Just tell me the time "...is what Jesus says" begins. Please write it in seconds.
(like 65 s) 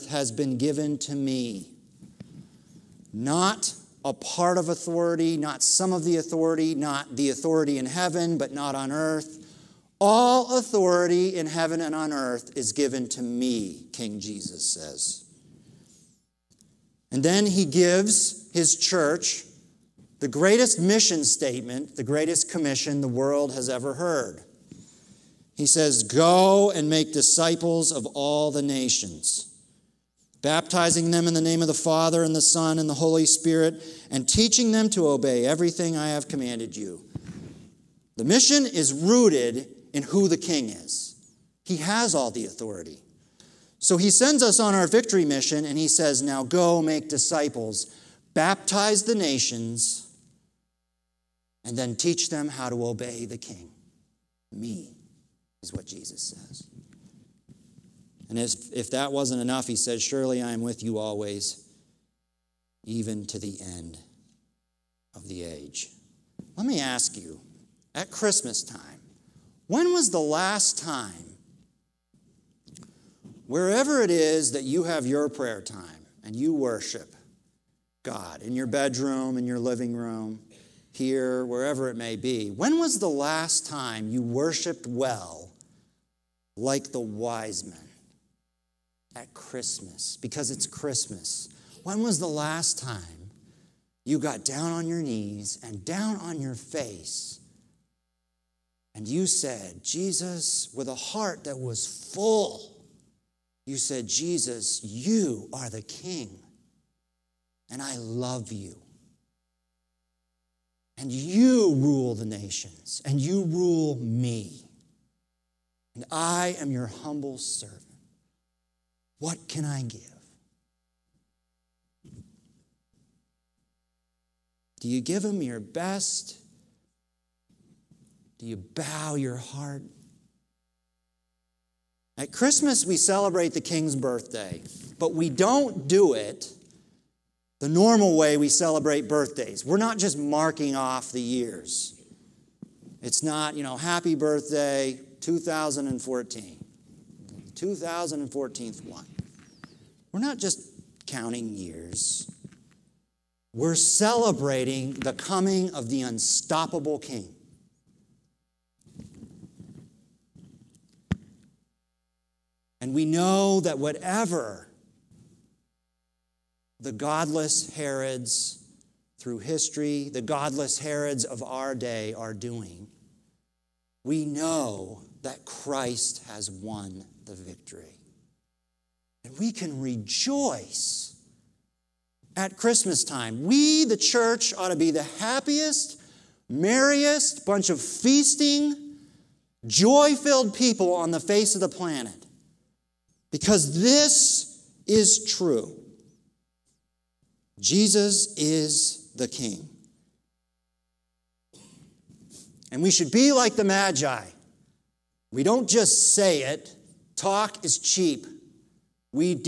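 55 s.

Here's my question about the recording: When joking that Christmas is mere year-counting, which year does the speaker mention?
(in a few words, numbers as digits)
2014.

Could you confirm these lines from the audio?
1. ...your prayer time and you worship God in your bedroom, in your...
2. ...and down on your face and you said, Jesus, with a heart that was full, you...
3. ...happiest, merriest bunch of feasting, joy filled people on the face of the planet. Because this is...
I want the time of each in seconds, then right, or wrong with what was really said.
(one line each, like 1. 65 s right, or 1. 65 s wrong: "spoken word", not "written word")
1. 75 s right
2. 95 s right
3. 185 s right.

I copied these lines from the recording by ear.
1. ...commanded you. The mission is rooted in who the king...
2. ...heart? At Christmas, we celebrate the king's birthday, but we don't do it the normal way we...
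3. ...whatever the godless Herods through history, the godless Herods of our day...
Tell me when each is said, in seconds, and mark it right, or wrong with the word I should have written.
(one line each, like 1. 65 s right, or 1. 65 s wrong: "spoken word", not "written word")
1. 36 s right
2. 129 s right
3. 163 s right.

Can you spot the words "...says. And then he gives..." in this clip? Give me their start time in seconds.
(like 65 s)
14 s.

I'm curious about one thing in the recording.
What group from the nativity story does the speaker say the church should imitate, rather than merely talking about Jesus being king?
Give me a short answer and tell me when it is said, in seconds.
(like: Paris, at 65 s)
the Magi, at 203 s.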